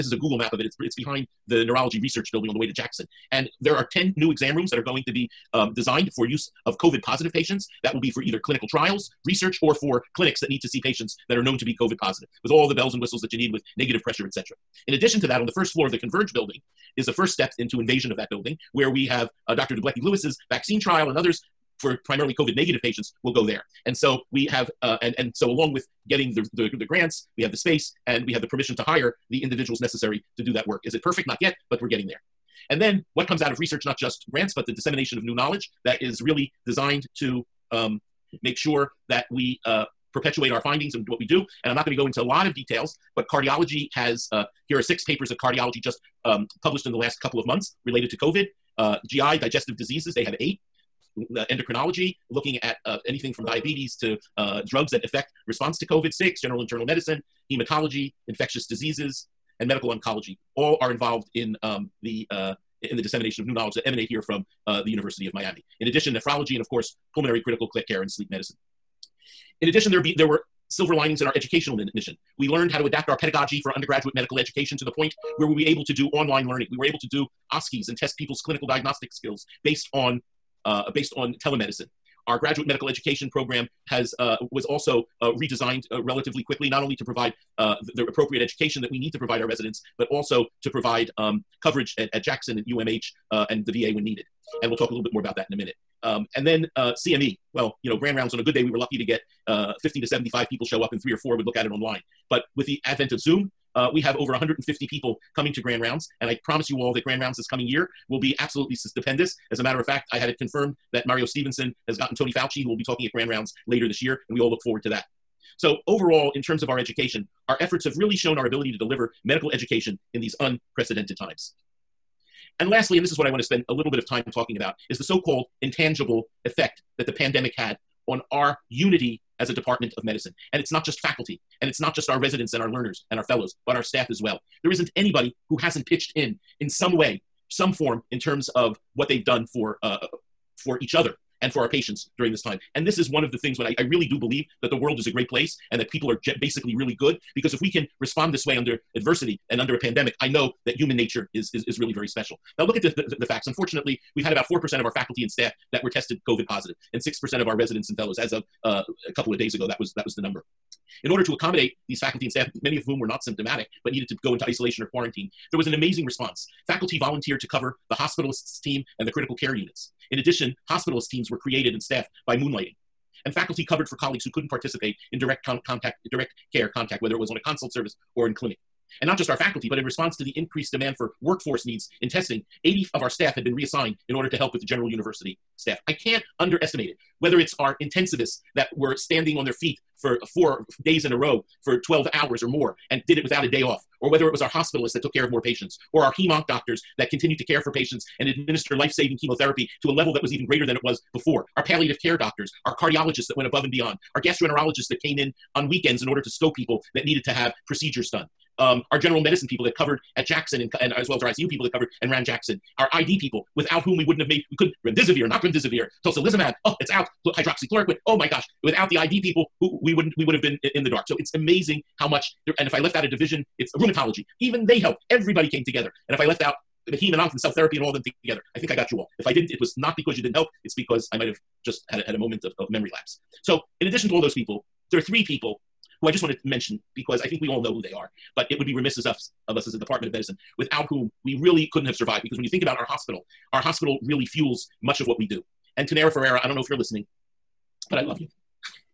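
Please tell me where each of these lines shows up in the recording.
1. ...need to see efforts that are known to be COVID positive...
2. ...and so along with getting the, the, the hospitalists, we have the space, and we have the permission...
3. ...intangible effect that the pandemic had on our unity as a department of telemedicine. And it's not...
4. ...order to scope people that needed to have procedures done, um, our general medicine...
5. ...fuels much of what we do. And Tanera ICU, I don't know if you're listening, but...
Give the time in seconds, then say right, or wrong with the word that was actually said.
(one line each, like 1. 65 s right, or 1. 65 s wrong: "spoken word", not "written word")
1. 10 s wrong: "patients", not "efforts"
2. 25 s wrong: "grants", not "hospitalists"
3. 125 s wrong: "medicine", not "telemedicine"
4. 206 s right
5. 244 s wrong: "Ferreira", not "ICU".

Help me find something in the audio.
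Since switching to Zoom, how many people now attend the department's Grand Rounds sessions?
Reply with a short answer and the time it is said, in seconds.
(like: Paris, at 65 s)
over 150, at 104 s.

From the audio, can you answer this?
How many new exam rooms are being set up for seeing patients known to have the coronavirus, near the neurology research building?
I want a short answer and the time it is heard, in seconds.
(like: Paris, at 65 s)
10, at 3 s.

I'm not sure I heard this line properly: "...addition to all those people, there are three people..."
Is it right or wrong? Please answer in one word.
right.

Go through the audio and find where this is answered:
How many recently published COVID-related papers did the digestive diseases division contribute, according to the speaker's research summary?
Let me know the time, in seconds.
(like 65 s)
50 s.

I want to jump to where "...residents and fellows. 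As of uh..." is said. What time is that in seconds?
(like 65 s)
157 s.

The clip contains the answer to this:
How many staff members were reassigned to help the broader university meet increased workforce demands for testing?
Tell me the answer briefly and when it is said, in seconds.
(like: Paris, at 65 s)
80, at 182 s.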